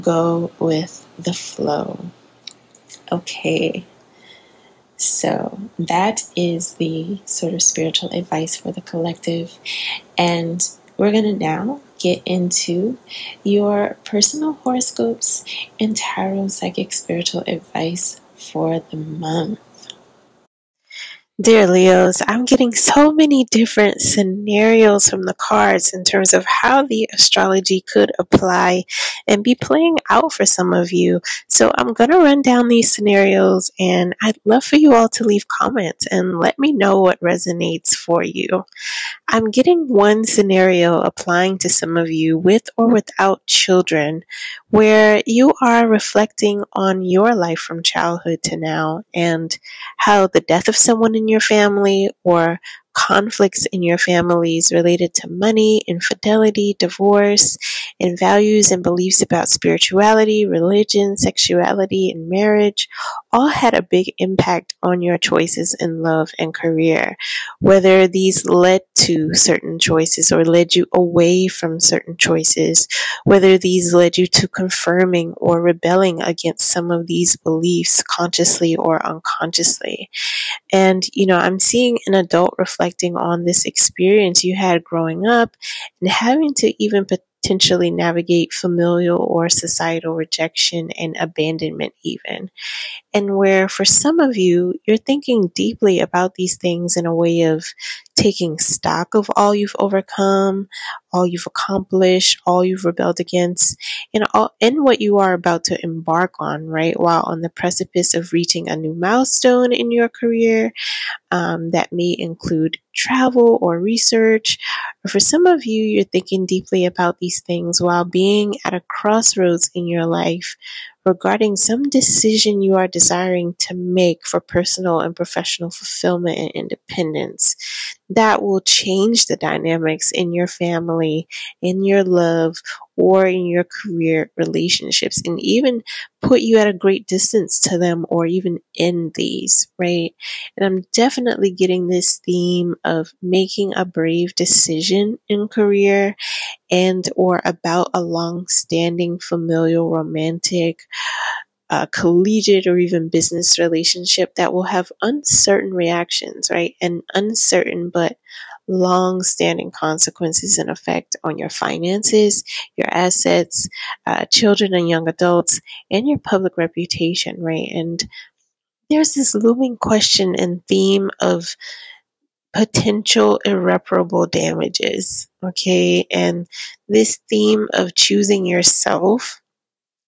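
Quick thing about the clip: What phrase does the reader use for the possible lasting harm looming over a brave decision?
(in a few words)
Irreparable damages.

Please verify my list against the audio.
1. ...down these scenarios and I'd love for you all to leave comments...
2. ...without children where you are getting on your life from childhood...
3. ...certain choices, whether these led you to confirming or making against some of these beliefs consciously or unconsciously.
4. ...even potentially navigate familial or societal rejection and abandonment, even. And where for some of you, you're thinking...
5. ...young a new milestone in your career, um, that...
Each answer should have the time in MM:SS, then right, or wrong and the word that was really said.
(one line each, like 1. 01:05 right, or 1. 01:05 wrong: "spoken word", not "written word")
1. 00:32 right
2. 00:42 wrong: "reflecting", not "getting"
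3. 01:11 wrong: "rebelling", not "making"
4. 01:26 right
5. 01:48 wrong: "reaching", not "young".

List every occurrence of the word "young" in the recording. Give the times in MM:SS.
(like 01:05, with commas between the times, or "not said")
02:44.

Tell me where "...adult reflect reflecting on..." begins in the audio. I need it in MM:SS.
01:22.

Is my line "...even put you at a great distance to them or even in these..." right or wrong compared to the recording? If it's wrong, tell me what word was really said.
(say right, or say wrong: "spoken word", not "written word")
right.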